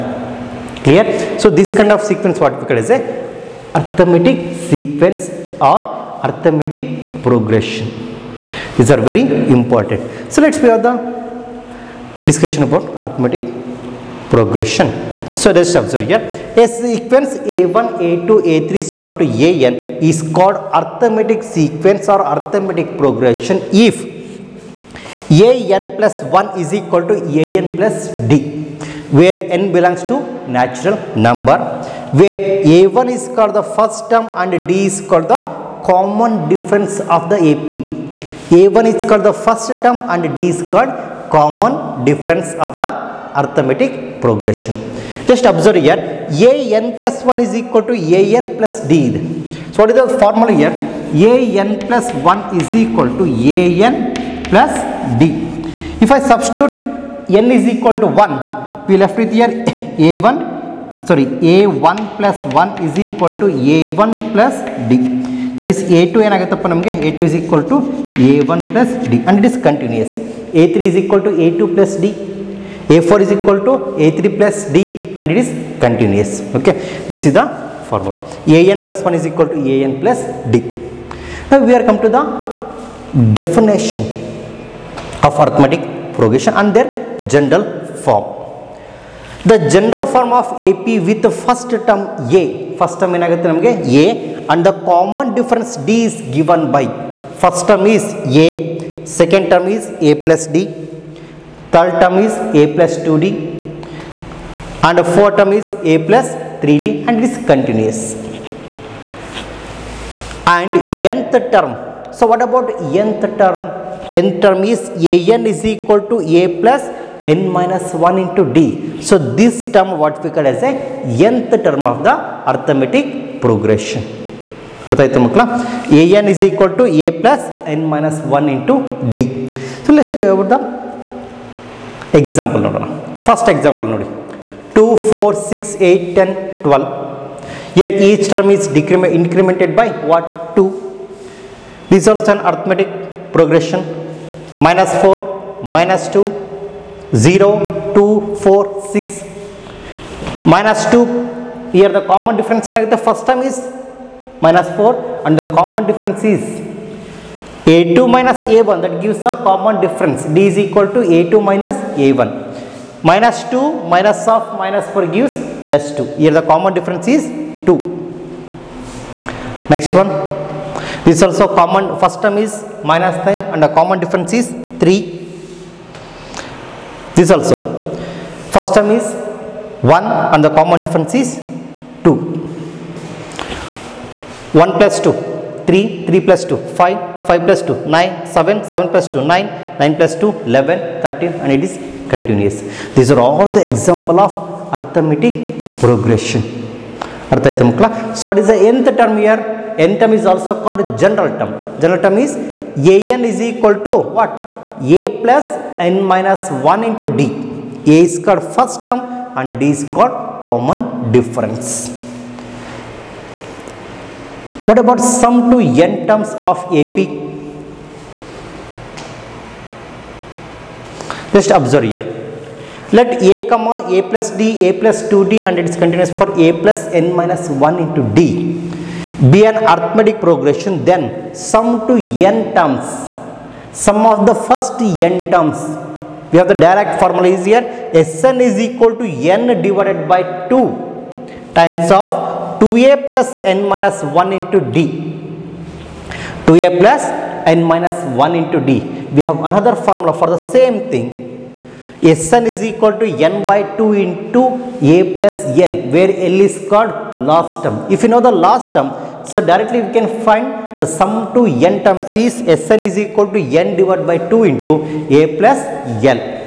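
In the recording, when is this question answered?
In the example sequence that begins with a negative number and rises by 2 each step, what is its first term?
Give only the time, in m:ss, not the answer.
2:32.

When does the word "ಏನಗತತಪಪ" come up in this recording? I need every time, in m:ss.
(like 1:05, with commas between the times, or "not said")
1:06.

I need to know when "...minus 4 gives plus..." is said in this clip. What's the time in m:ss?
2:44.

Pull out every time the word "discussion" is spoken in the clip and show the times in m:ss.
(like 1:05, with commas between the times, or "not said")
0:12.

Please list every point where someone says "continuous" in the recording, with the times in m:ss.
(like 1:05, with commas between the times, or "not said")
1:47, 3:12, 3:45.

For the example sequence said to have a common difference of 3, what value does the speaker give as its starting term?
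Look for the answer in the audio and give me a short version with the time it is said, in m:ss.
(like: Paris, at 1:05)
-9, at 2:52.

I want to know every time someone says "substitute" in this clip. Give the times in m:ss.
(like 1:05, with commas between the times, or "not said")
0:56.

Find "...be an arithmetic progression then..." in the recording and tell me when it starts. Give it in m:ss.
3:49.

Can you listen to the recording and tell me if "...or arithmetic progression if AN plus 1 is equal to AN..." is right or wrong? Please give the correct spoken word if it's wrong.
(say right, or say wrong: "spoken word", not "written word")
right.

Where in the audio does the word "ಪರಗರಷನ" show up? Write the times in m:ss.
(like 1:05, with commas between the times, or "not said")
0:07, 2:23.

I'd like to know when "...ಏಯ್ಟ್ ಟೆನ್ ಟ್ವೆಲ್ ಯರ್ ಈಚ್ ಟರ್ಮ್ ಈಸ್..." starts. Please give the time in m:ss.
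2:15.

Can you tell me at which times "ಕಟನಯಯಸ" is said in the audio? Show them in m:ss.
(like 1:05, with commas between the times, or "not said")
1:09, 1:15.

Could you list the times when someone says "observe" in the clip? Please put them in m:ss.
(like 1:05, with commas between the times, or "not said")
0:15, 0:45, 3:41.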